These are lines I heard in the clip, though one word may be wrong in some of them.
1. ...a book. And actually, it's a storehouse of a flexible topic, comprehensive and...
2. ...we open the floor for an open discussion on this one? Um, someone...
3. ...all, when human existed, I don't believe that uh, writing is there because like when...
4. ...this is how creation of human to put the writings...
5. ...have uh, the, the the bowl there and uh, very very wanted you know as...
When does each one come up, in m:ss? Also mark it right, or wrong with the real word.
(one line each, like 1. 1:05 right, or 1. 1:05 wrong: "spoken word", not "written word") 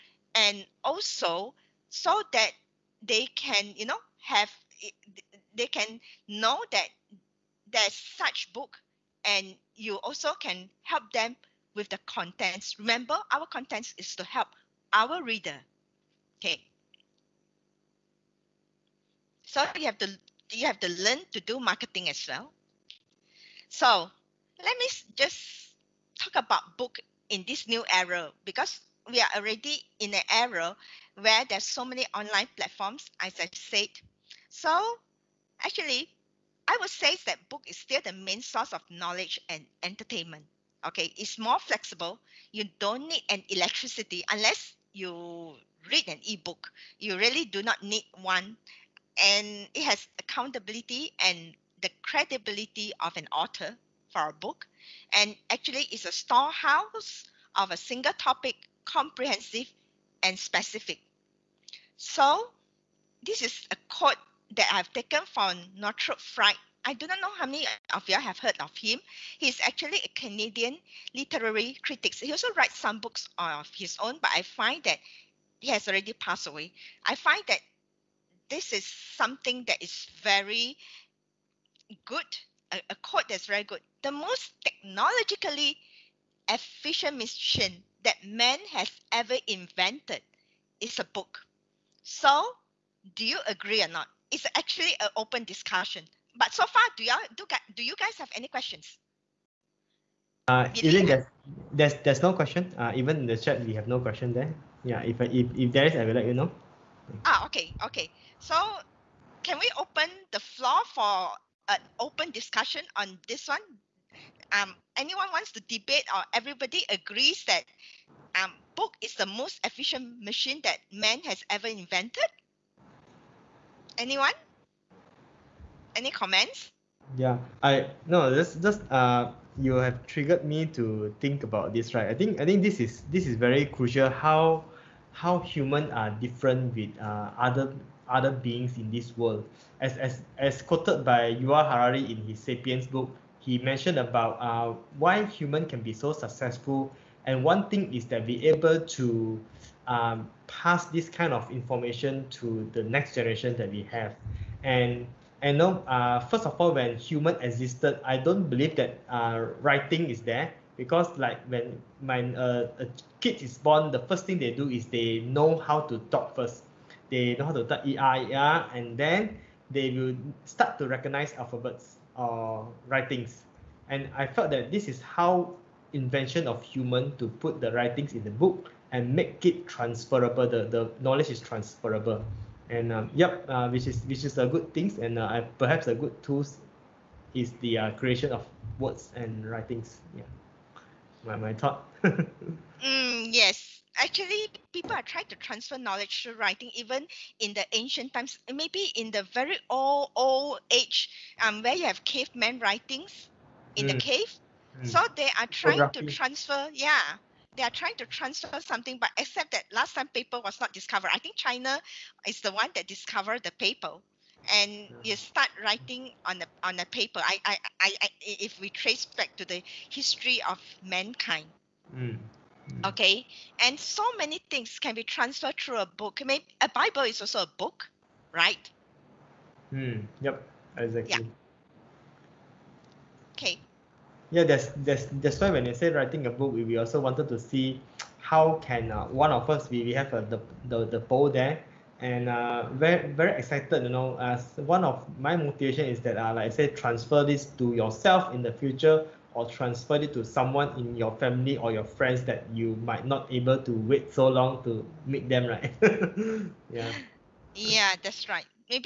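1. 0:54 wrong: "single", not "flexible"
2. 1:49 wrong: "anyone", not "someone"
3. 2:36 right
4. 2:54 wrong: "invention", not "creation"
5. 3:59 wrong: "excited", not "wanted".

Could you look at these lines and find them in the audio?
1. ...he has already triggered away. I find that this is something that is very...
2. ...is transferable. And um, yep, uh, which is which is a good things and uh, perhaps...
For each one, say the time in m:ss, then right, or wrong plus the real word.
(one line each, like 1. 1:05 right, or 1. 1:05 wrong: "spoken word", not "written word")
1. 1:15 wrong: "passed", not "triggered"
2. 3:01 right.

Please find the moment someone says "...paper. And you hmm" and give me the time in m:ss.
3:33.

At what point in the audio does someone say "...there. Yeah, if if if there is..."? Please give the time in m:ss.
1:44.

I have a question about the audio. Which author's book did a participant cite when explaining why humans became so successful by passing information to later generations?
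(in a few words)
Yuval Harari.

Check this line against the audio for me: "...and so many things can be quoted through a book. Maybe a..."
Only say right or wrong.
wrong.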